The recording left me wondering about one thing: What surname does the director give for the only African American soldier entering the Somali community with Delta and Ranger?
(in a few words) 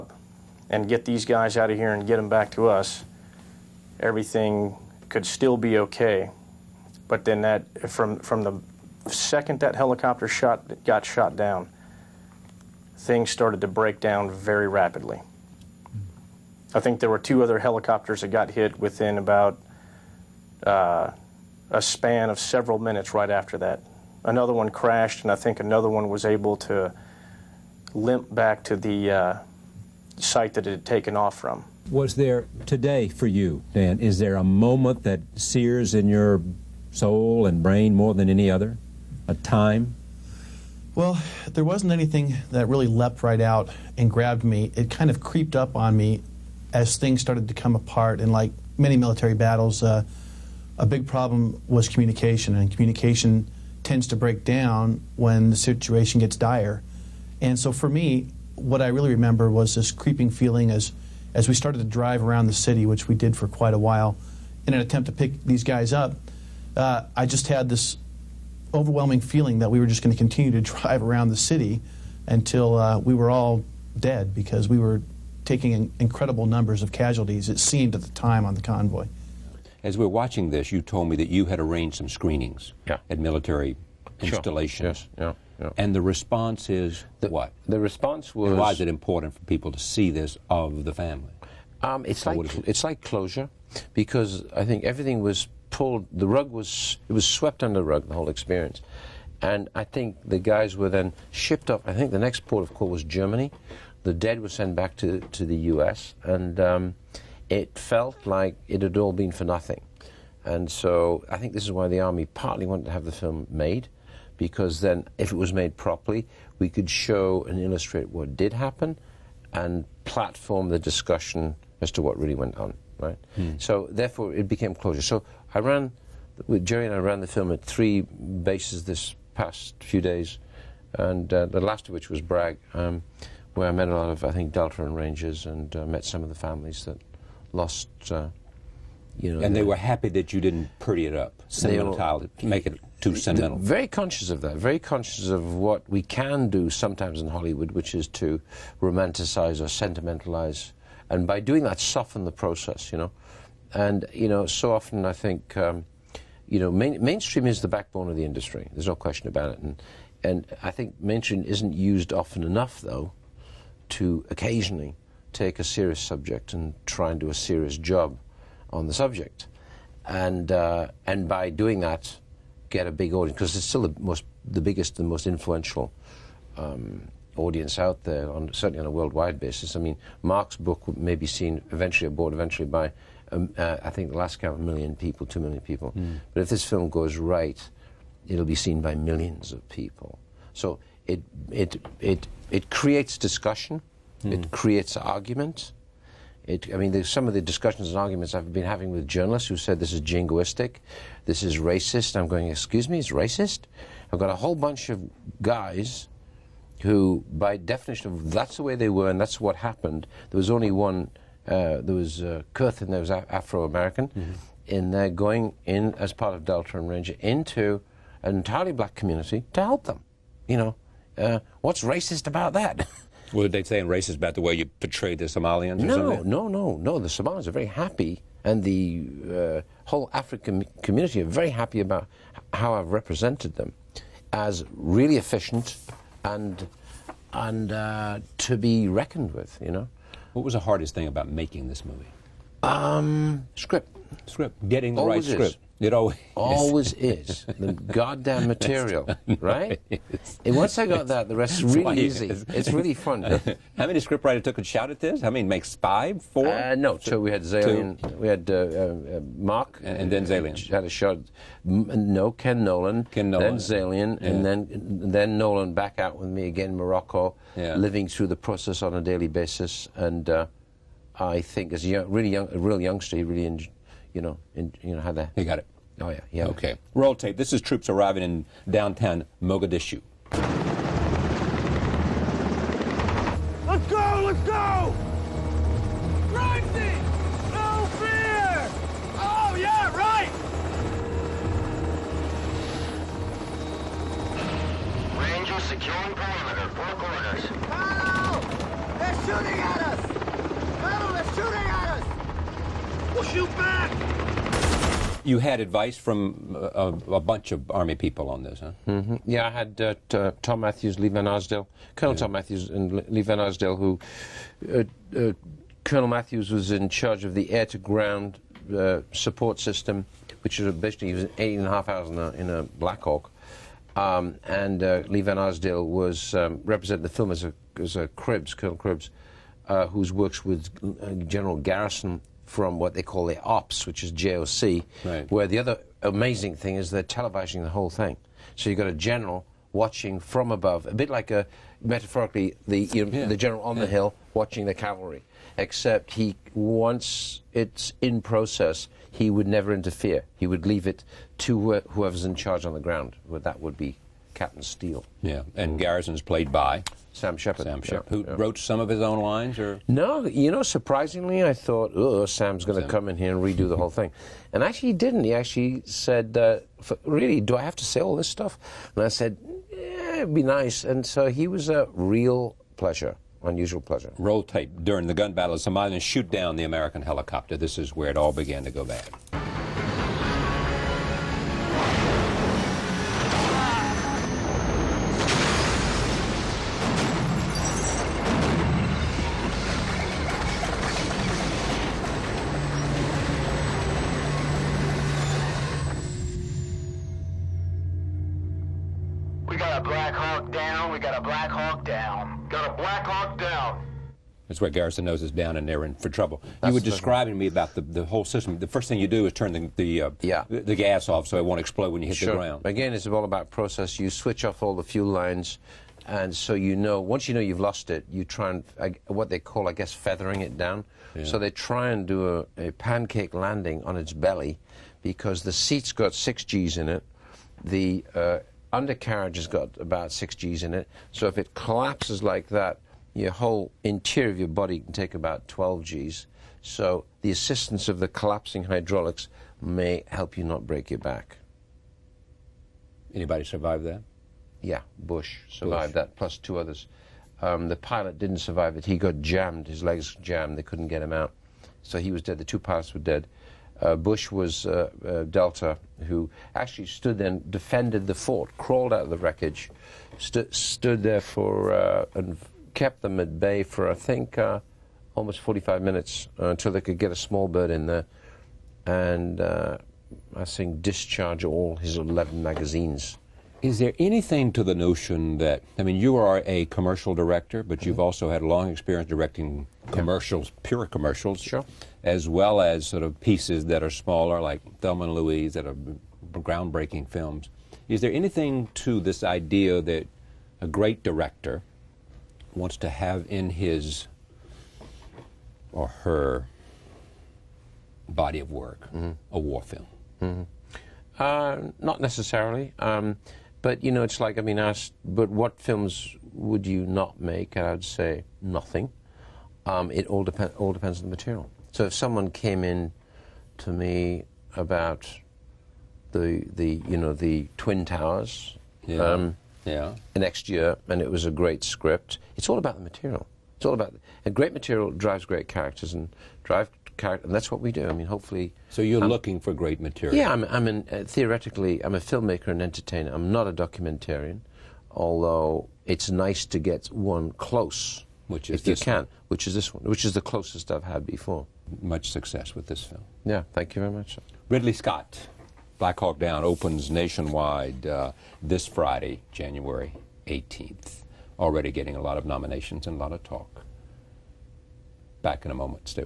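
Kurth.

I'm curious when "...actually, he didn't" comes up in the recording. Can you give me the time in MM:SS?
06:04.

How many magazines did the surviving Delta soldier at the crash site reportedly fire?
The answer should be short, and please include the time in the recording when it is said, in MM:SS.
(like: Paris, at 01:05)
11, at 07:51.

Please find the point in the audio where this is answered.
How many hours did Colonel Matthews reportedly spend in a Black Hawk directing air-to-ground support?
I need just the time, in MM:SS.
05:21.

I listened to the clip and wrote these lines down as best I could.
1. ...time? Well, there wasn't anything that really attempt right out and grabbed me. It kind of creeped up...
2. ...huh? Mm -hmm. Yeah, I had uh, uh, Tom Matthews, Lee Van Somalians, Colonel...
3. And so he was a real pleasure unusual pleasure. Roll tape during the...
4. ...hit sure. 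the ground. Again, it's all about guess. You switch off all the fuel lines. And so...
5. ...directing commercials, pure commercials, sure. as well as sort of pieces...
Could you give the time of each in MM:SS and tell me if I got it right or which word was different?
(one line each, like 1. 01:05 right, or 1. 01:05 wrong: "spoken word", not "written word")
1. 00:39 wrong: "leapt", not "attempt"
2. 05:08 wrong: "Arsdale", not "Somalians"
3. 06:10 right
4. 06:52 wrong: "process", not "guess"
5. 07:59 right.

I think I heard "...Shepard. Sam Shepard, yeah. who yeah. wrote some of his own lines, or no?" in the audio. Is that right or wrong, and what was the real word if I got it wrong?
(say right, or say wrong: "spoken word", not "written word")
right.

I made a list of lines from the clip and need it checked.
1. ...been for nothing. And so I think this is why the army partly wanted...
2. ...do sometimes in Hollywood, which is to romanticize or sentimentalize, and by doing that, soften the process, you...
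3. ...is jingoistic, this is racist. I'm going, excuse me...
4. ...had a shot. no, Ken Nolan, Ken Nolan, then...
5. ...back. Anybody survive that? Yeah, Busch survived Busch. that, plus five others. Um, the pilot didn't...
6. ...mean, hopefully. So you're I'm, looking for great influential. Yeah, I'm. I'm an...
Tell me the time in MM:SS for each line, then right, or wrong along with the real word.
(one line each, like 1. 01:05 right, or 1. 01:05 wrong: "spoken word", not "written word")
1. 01:49 right
2. 02:26 right
3. 03:19 right
4. 04:20 right
5. 07:20 wrong: "two", not "five"
6. 08:47 wrong: "material", not "influential".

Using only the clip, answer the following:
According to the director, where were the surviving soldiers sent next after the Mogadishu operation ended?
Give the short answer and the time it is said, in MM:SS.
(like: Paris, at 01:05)
Germany, at 01:43.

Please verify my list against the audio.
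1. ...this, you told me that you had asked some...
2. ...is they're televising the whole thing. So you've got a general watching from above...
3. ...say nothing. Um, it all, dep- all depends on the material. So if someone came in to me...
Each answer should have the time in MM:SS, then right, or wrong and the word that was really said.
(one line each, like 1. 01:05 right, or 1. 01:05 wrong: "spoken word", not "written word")
1. 01:20 wrong: "arranged", not "asked"
2. 05:36 right
3. 08:27 right.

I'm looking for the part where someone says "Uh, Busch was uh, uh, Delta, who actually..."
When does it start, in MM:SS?
07:33.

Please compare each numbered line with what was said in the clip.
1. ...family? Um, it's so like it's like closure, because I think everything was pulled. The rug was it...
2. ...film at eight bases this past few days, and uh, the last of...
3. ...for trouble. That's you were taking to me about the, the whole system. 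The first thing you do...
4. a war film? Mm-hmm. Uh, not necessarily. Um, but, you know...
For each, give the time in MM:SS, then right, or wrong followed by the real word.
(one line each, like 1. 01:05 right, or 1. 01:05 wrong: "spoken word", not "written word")
1. 01:30 right
2. 02:07 wrong: "three", not "eight"
3. 06:45 wrong: "describing", not "taking"
4. 08:19 right.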